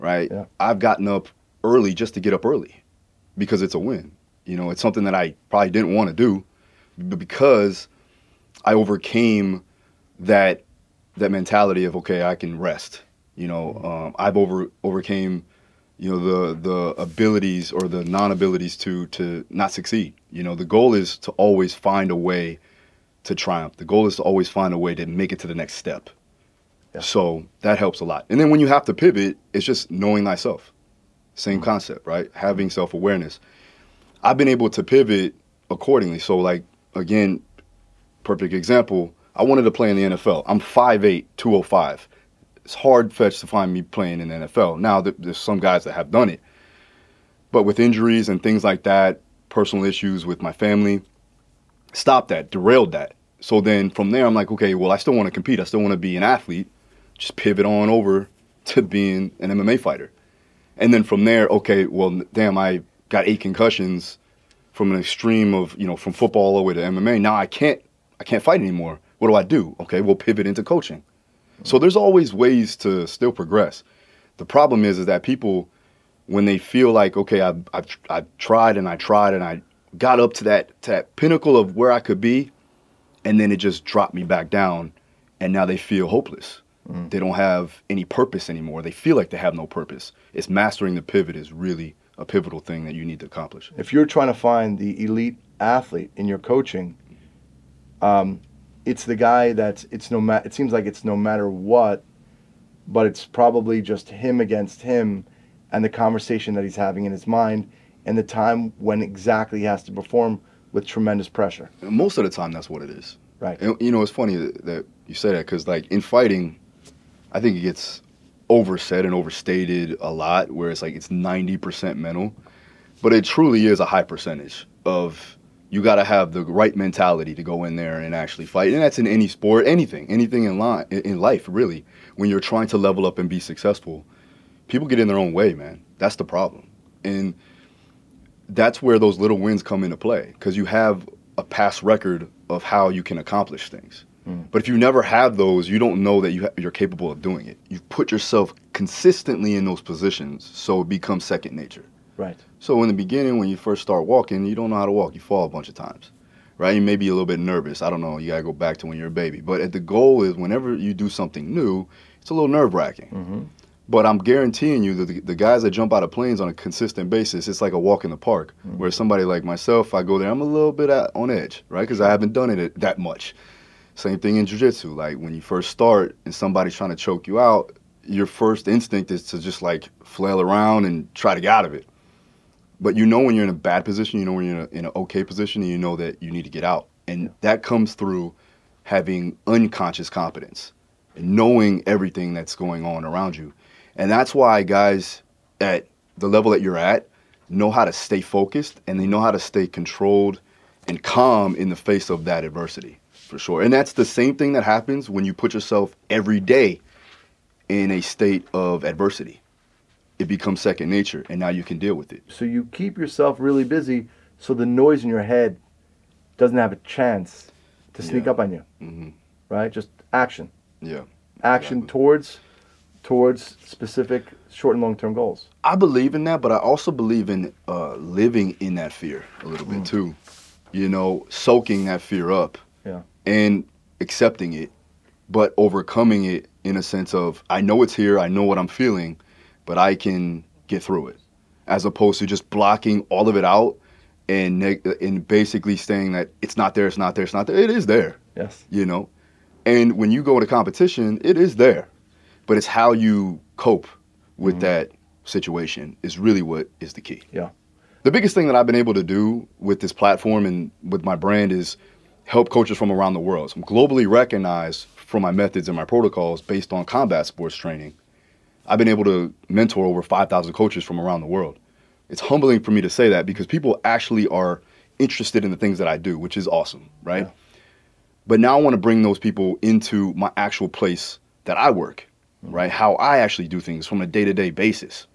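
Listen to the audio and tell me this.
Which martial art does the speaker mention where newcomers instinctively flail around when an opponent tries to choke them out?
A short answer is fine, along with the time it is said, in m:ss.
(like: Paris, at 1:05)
Jujitsu, at 2:54.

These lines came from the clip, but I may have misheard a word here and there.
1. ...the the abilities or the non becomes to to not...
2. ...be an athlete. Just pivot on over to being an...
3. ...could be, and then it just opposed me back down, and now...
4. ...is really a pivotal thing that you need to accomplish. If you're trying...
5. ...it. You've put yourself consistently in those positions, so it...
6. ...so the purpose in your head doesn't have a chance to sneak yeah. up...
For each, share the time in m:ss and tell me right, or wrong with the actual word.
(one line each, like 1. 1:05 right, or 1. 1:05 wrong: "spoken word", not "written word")
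1. 0:16 wrong: "abilities", not "becomes"
2. 0:55 right
3. 1:21 wrong: "dropped", not "opposed"
4. 1:31 right
5. 2:27 right
6. 3:34 wrong: "noise", not "purpose".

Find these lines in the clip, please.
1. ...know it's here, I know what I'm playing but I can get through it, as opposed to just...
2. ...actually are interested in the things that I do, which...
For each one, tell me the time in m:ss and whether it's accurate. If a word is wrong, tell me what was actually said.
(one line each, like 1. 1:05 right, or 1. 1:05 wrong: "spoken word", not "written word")
1. 3:57 wrong: "feeling", not "playing"
2. 4:33 right.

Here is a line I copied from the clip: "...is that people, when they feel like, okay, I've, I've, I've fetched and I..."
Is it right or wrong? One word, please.
wrong.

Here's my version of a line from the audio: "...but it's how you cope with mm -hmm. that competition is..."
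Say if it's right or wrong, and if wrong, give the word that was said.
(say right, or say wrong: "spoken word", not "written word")
wrong: "situation", not "competition".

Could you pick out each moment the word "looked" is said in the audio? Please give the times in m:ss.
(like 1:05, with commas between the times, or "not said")
not said.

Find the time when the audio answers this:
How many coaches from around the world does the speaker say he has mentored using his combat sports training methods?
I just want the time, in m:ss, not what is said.
4:30.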